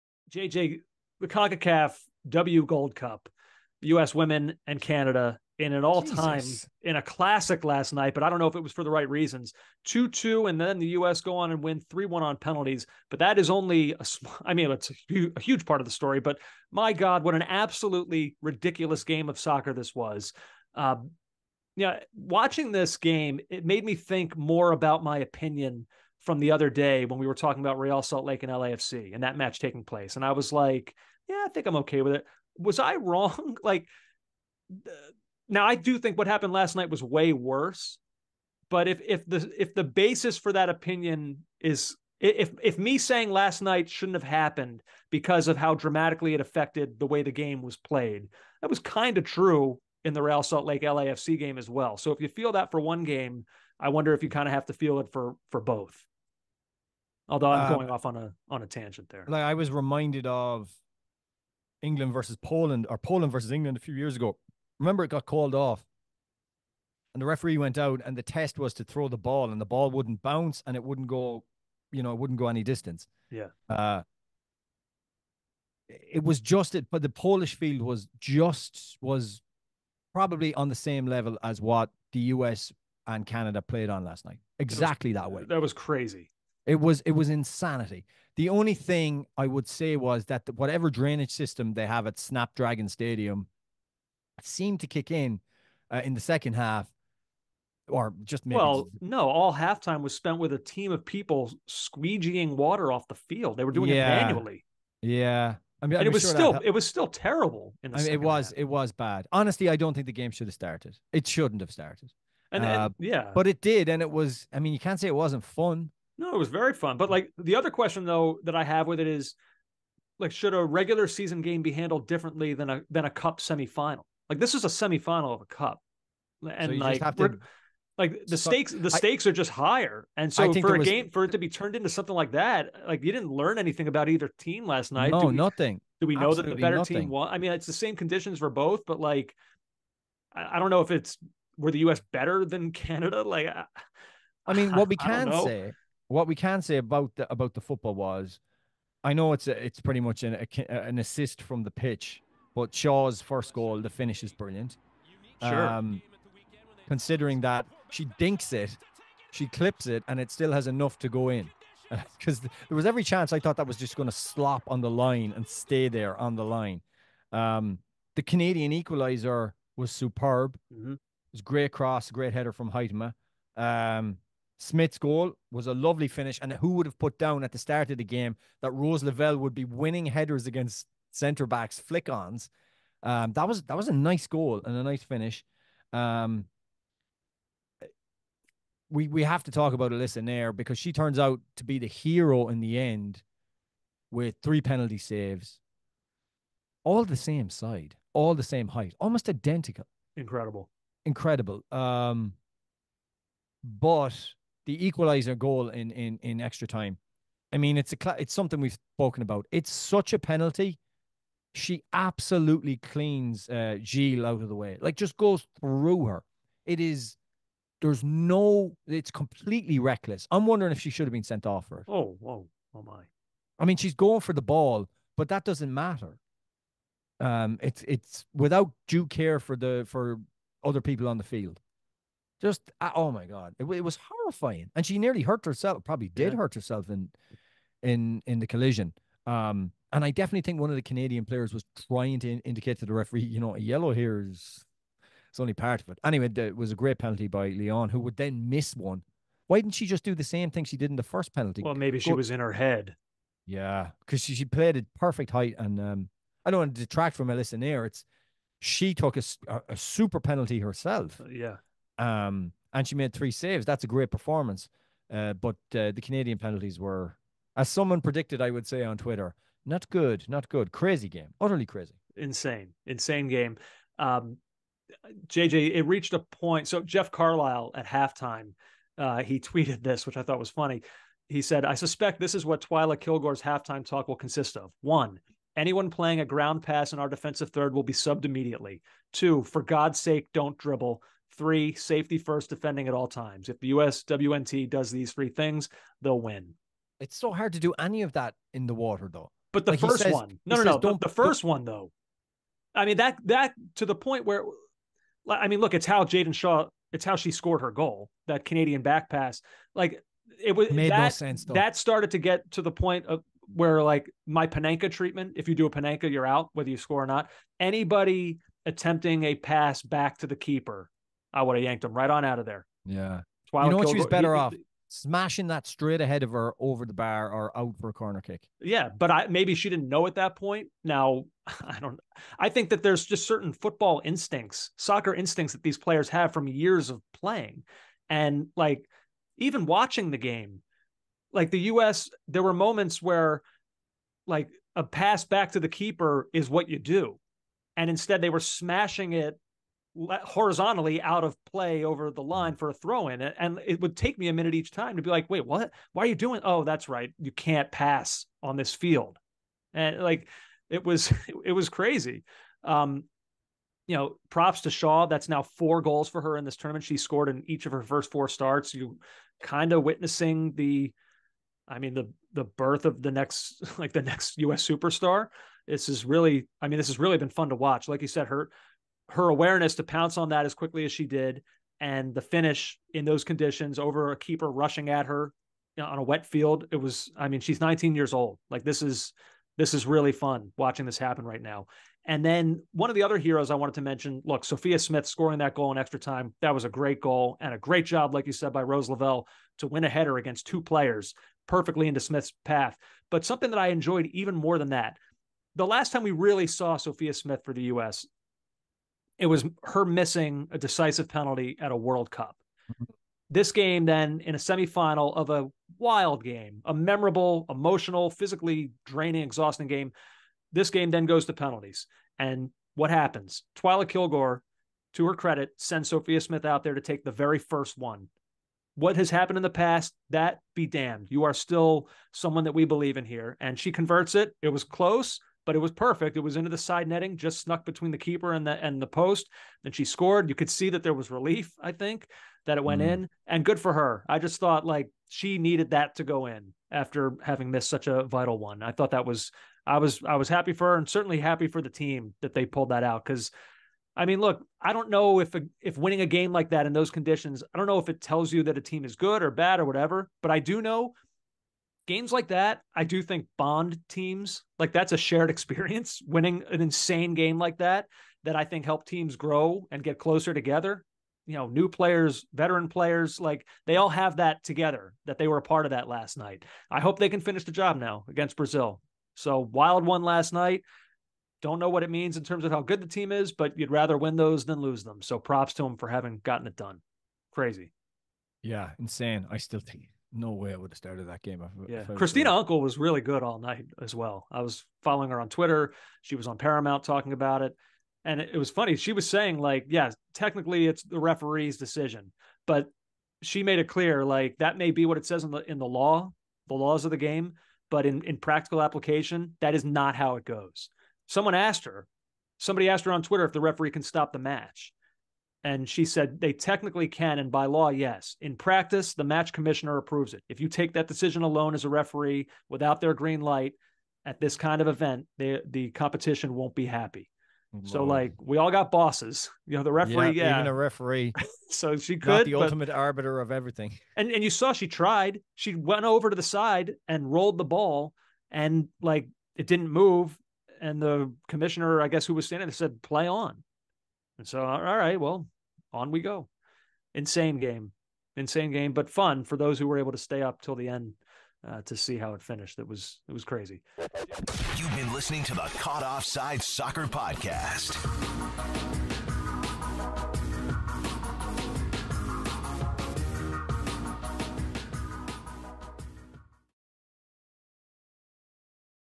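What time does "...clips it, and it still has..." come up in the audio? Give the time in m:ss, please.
2:39.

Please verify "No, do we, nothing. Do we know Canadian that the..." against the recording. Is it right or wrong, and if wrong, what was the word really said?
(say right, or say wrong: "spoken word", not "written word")
wrong: "Absolutely", not "Canadian".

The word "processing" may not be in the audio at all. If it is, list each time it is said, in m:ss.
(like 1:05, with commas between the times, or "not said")
not said.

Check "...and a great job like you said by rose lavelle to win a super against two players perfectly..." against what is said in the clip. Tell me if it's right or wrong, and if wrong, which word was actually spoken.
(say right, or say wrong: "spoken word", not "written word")
wrong: "header", not "super".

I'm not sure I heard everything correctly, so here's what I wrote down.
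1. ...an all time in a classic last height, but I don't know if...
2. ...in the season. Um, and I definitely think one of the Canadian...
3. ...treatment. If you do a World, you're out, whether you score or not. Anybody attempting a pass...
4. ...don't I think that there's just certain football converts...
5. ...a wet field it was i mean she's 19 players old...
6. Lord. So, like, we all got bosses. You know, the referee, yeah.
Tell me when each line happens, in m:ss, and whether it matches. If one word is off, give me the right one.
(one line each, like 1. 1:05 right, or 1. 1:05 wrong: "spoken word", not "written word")
1. 0:05 wrong: "night", not "height"
2. 3:58 wrong: "collision", not "season"
3. 5:14 wrong: "Panenka", not "World"
4. 5:31 wrong: "instincts", not "converts"
5. 6:25 wrong: "years", not "players"
6. 8:47 right.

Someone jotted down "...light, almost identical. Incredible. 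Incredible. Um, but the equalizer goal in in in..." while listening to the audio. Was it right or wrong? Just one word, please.
wrong.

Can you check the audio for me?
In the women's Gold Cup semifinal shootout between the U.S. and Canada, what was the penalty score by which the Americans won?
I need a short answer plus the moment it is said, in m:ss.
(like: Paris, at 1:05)
3-1, at 0:11.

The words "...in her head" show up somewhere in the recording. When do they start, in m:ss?
4:12.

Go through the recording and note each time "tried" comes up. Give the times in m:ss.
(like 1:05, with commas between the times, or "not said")
8:54.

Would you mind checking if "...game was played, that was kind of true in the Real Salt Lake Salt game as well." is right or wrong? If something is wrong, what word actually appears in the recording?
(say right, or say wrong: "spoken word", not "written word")
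wrong: "LAFC", not "Salt".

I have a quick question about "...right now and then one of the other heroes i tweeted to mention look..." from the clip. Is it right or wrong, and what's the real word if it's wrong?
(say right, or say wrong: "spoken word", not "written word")
wrong: "wanted", not "tweeted".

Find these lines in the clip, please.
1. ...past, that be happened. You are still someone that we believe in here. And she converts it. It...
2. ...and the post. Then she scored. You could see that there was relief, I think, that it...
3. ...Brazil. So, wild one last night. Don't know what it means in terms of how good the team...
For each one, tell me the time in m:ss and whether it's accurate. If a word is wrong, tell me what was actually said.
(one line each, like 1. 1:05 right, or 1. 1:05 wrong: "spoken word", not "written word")
1. 7:09 wrong: "damned", not "happened"
2. 7:18 right
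3. 7:58 right.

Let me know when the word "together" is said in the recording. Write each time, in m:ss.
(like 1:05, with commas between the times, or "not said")
7:50, 7:54.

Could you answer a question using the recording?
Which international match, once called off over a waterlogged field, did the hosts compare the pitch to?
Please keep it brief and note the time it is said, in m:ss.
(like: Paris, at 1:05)
England versus Poland, at 1:01.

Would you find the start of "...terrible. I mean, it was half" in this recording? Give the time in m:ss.
1:47.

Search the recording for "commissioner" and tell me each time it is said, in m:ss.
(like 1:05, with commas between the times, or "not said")
8:39, 9:01.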